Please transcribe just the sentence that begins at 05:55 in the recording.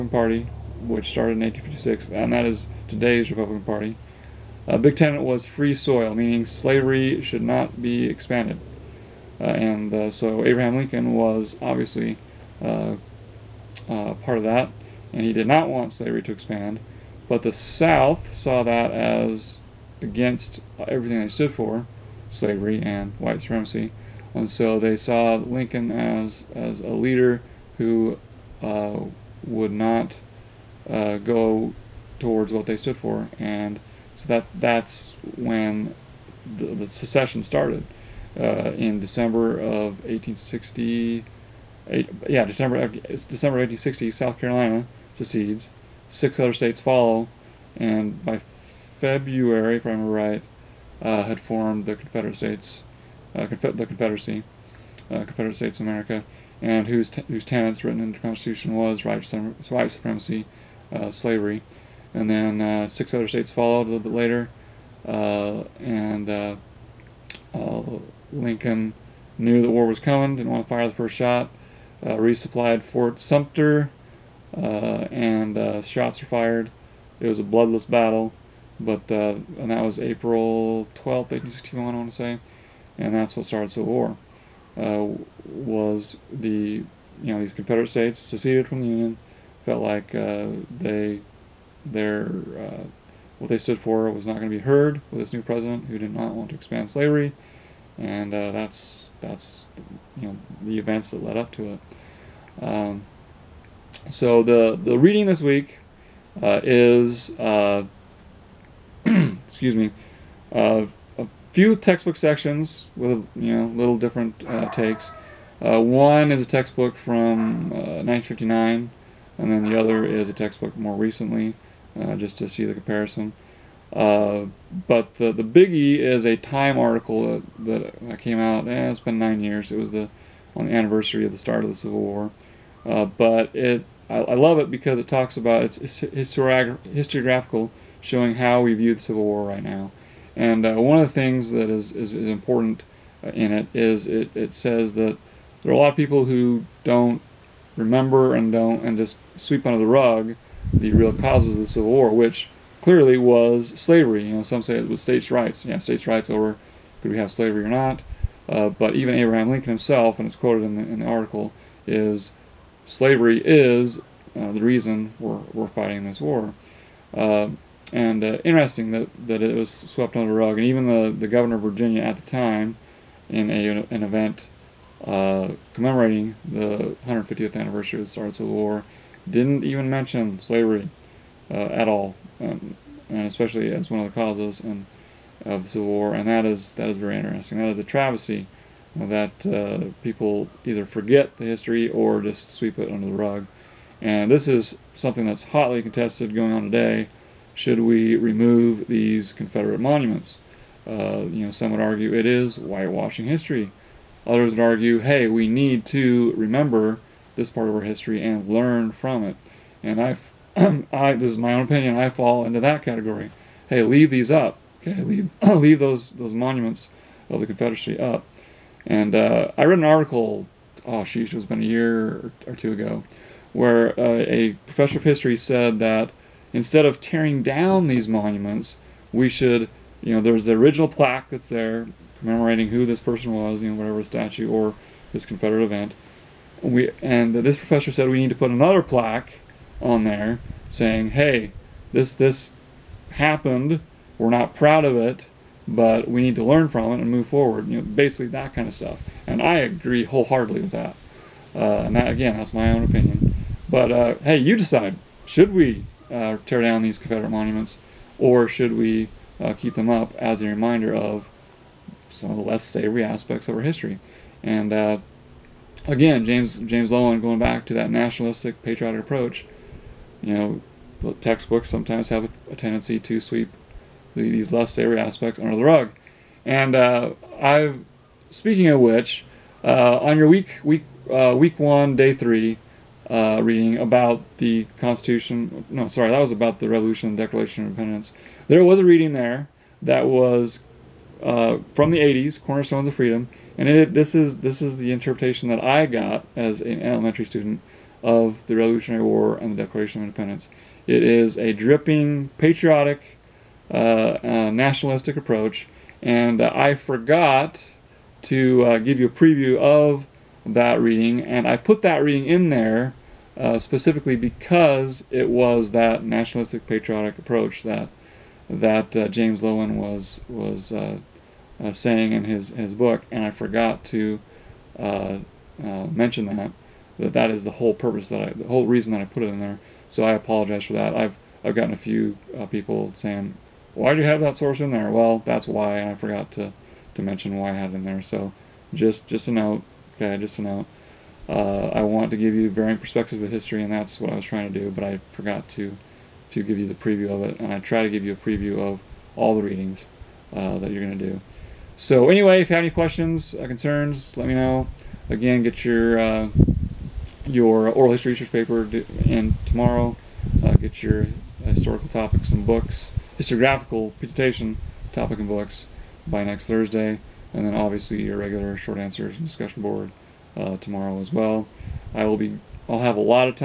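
Again, get your uh, your oral history research paper in tomorrow.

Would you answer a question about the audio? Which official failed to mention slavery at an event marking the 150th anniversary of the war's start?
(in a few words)
governor of Virginia.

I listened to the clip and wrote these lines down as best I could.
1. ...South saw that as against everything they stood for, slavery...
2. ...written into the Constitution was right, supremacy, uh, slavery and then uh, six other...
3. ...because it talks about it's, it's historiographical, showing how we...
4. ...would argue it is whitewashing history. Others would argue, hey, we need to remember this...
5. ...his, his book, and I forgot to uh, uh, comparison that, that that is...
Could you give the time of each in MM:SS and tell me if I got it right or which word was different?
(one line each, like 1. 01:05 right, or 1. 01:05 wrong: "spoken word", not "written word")
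1. 00:17 right
2. 00:57 right
3. 02:14 right
4. 03:21 right
5. 05:22 wrong: "mention", not "comparison".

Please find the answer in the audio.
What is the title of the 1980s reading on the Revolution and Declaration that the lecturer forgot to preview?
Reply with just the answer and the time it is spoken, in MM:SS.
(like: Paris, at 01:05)
Cornerstones of Freedom, at 04:52.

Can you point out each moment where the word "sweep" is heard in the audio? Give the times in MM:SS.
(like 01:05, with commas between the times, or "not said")
02:29, 03:12, 04:33.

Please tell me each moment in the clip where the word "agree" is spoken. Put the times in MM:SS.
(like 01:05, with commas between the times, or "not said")
04:09.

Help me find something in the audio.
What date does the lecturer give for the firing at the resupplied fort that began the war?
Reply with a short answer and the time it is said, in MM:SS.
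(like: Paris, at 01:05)
April 12th, 1861, at 01:19.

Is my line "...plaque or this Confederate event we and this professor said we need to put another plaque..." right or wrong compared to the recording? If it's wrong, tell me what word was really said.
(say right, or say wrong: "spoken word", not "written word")
wrong: "statue", not "plaque".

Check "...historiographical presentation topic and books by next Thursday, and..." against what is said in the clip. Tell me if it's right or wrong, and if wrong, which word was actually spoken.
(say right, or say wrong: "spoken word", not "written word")
right.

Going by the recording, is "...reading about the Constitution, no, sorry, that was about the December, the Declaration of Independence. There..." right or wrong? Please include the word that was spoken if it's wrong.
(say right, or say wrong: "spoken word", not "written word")
wrong: "Revolution", not "December".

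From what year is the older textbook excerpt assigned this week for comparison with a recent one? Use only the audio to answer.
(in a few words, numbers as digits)
1959.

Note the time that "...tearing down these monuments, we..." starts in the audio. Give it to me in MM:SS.
03:46.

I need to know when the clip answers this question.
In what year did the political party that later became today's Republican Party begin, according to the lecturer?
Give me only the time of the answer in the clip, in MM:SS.
00:01.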